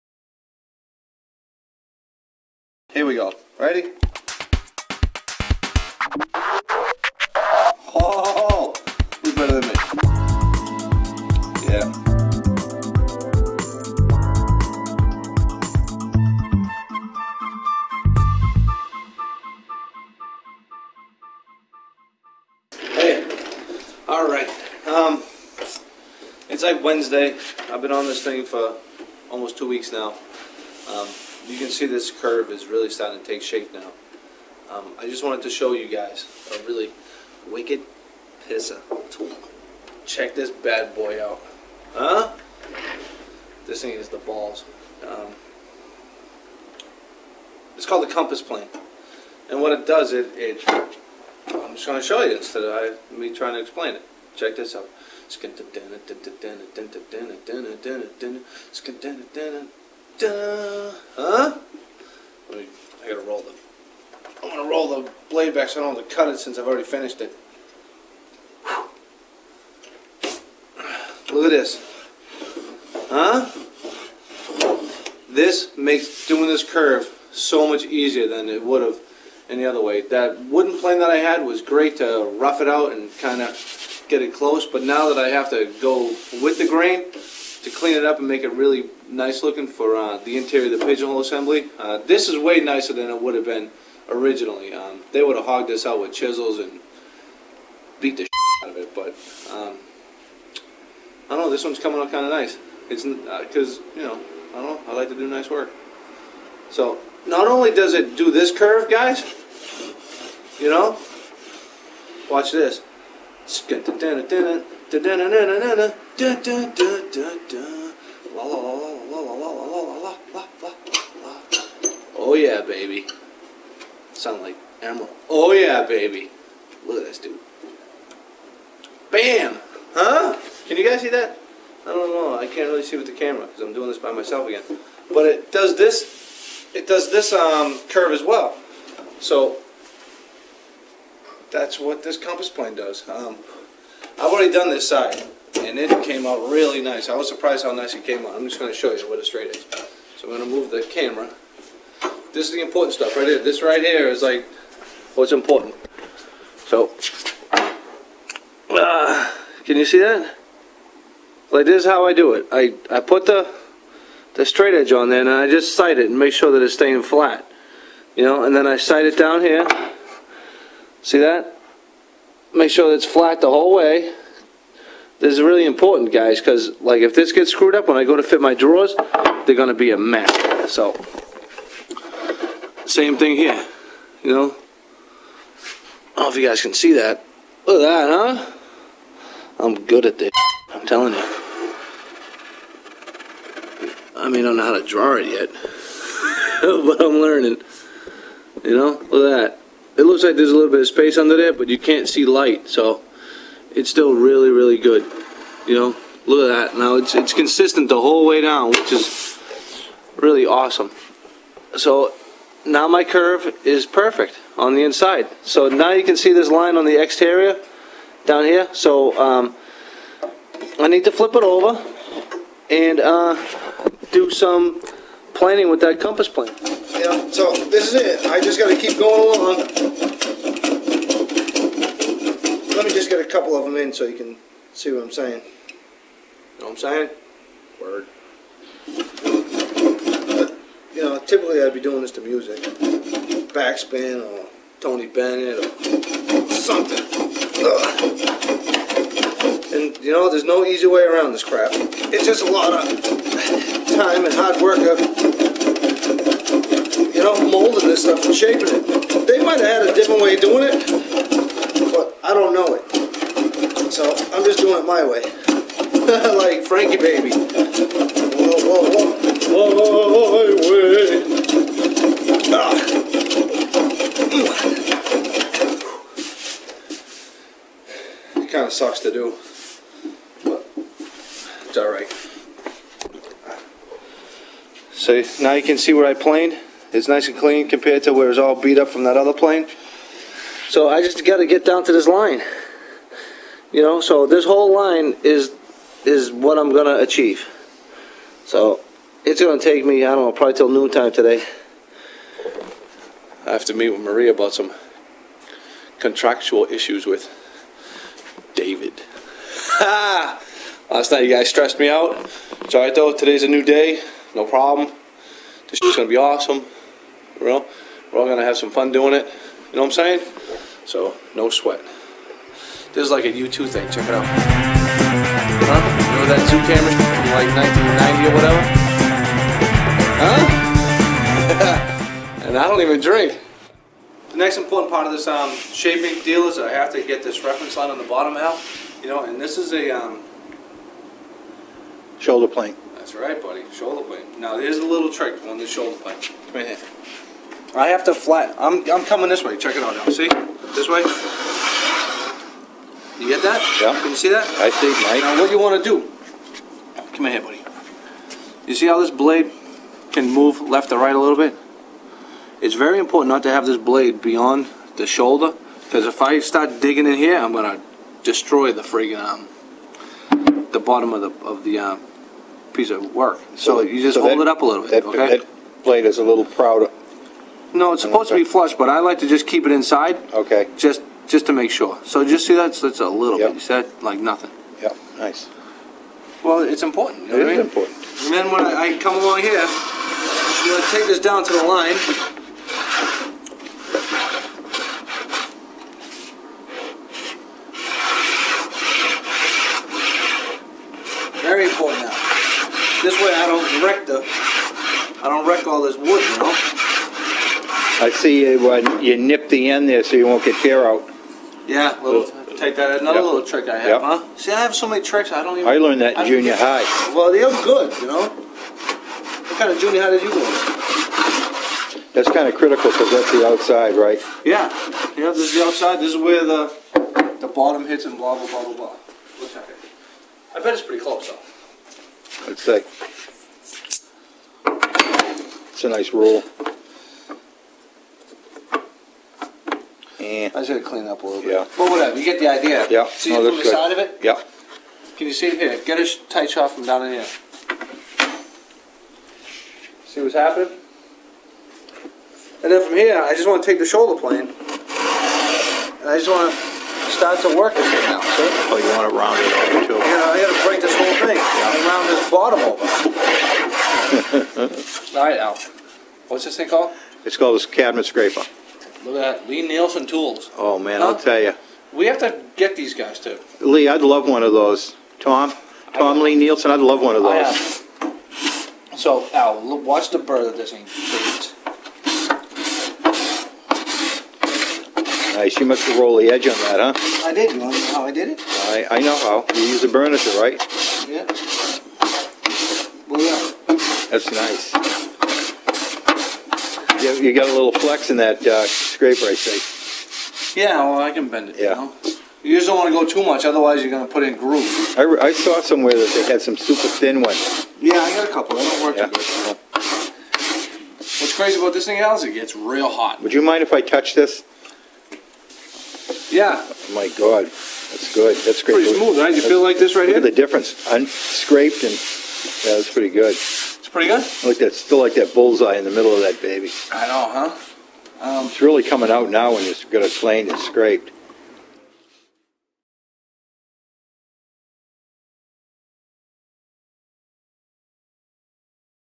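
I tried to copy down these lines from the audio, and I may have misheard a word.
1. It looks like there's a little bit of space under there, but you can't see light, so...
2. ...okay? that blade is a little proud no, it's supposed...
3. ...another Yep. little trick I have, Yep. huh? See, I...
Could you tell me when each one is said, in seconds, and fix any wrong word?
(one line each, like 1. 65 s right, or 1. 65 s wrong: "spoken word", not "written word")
1. 200 s right
2. 375 s right
3. 412 s right.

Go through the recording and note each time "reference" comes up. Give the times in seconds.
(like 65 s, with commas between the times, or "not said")
337 s.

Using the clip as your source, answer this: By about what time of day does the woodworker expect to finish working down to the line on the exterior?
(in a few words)
noontime.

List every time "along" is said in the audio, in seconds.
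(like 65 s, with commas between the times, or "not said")
229 s, 389 s.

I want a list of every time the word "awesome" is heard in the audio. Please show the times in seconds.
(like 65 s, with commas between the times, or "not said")
210 s, 316 s.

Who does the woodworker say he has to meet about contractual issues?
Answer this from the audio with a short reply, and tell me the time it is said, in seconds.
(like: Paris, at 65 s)
Maria, at 303 s.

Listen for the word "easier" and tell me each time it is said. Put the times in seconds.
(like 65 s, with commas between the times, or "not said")
77 s.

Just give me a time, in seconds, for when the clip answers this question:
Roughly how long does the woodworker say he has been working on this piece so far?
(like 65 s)
29 s.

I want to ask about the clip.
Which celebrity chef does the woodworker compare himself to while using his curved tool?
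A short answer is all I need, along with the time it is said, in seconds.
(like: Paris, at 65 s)
Emeril, at 124 s.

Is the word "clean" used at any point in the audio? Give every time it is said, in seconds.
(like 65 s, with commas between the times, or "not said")
87 s, 287 s, 440 s.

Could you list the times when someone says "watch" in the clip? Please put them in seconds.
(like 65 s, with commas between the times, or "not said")
112 s, 479 s.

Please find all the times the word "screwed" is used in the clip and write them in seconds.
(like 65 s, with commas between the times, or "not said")
177 s.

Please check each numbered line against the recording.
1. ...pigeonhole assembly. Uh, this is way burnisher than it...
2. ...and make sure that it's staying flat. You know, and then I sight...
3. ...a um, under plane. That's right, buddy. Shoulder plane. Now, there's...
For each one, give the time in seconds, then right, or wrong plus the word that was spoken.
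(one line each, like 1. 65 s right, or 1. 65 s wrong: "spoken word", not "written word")
1. 90 s wrong: "nicer", not "burnisher"
2. 166 s right
3. 339 s wrong: "shoulder", not "under".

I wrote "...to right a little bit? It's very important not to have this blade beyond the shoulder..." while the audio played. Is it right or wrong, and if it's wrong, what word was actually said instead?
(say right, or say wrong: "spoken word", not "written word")
right.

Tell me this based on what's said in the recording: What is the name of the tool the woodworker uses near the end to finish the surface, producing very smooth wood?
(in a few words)
cabinet scraper.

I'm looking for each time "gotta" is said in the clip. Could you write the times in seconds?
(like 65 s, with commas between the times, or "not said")
63 s, 440 s.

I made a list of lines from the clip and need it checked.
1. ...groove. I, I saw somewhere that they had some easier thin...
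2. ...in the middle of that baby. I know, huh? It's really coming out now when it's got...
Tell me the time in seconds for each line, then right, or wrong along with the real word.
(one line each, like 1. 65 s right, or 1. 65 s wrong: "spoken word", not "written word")
1. 504 s wrong: "super", not "easier"
2. 525 s right.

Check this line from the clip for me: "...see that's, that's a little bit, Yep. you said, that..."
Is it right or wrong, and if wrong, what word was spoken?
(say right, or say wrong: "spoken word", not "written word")
right.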